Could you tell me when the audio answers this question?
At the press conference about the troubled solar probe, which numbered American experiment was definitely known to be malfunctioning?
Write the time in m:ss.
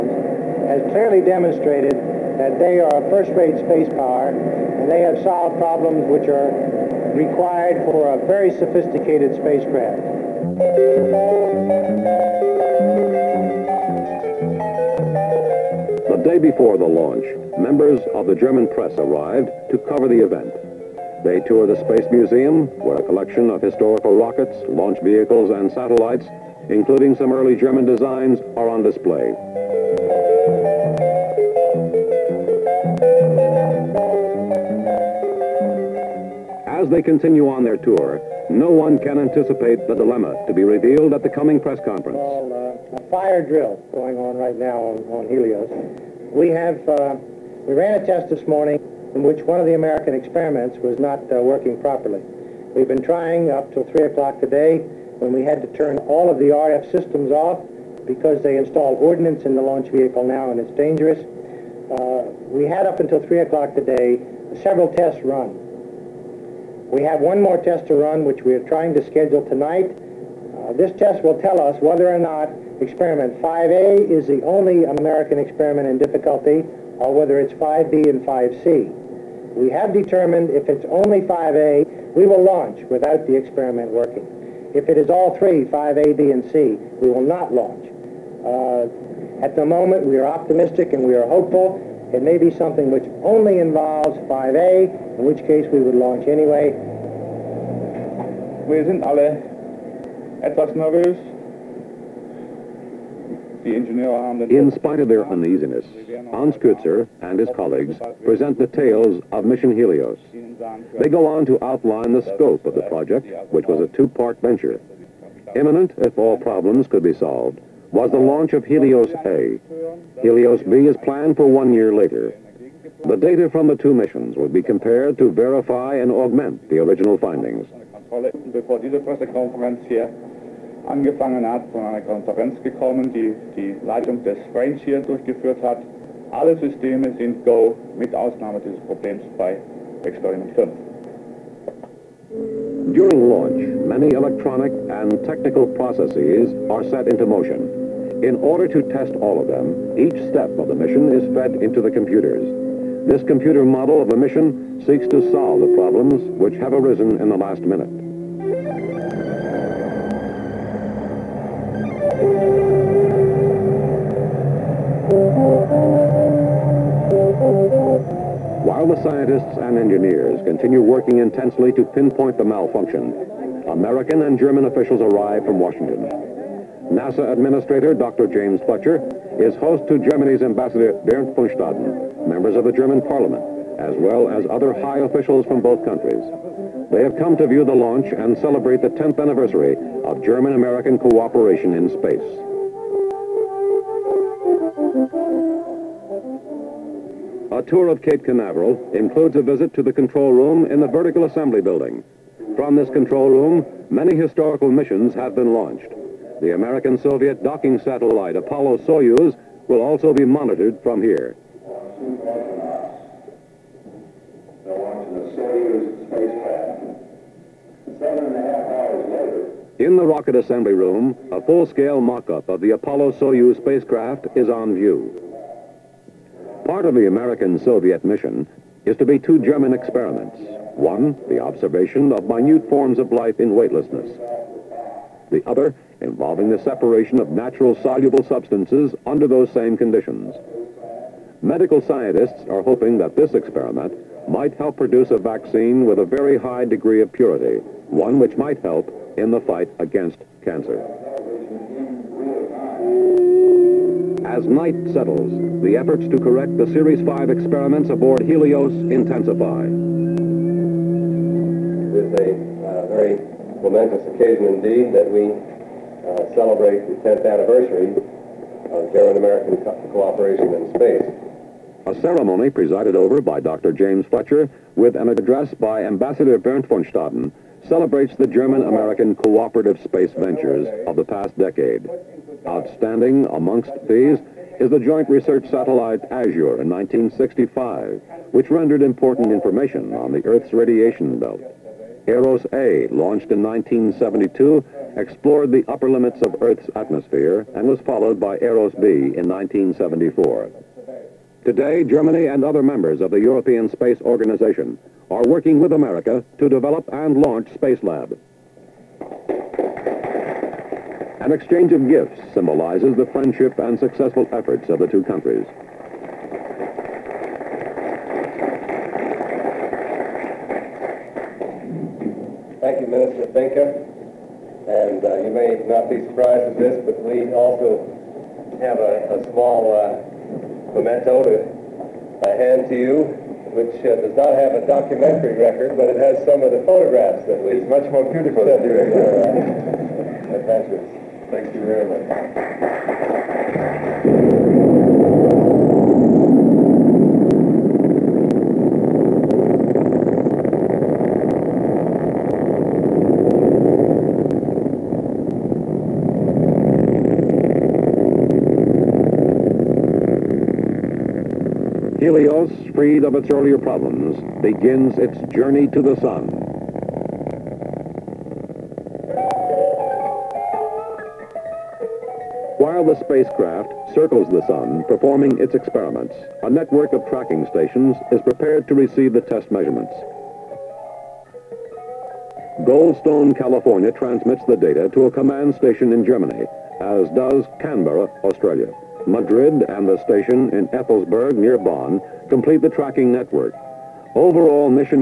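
1:12.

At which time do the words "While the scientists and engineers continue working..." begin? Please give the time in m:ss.
2:48.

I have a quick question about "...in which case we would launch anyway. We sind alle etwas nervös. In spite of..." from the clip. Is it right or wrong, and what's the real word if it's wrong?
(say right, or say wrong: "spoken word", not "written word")
right.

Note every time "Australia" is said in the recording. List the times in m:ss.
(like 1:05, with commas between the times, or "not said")
6:28.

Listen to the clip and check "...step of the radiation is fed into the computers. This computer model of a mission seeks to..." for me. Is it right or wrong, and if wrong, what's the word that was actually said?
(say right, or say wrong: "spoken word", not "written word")
wrong: "mission", not "radiation".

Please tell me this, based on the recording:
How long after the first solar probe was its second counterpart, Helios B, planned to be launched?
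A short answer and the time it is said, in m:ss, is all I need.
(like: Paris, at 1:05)
one year later, at 2:01.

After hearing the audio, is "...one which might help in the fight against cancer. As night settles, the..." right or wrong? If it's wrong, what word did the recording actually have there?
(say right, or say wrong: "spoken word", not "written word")
right.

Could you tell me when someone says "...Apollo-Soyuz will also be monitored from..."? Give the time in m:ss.
3:28.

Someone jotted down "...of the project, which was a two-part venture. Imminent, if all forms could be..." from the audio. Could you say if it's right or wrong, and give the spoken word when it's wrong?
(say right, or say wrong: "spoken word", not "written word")
wrong: "problems", not "forms".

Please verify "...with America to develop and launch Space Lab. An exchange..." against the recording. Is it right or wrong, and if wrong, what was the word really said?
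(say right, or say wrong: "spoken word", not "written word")
right.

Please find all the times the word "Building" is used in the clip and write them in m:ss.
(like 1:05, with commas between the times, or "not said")
3:21.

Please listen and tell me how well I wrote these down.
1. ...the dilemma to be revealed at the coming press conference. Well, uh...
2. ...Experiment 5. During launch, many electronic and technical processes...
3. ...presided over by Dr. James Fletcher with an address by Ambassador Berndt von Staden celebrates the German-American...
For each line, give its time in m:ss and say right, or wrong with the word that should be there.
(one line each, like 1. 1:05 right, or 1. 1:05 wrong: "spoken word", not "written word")
1. 0:39 right
2. 2:20 right
3. 4:32 right.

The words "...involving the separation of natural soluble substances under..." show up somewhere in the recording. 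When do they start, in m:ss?
3:56.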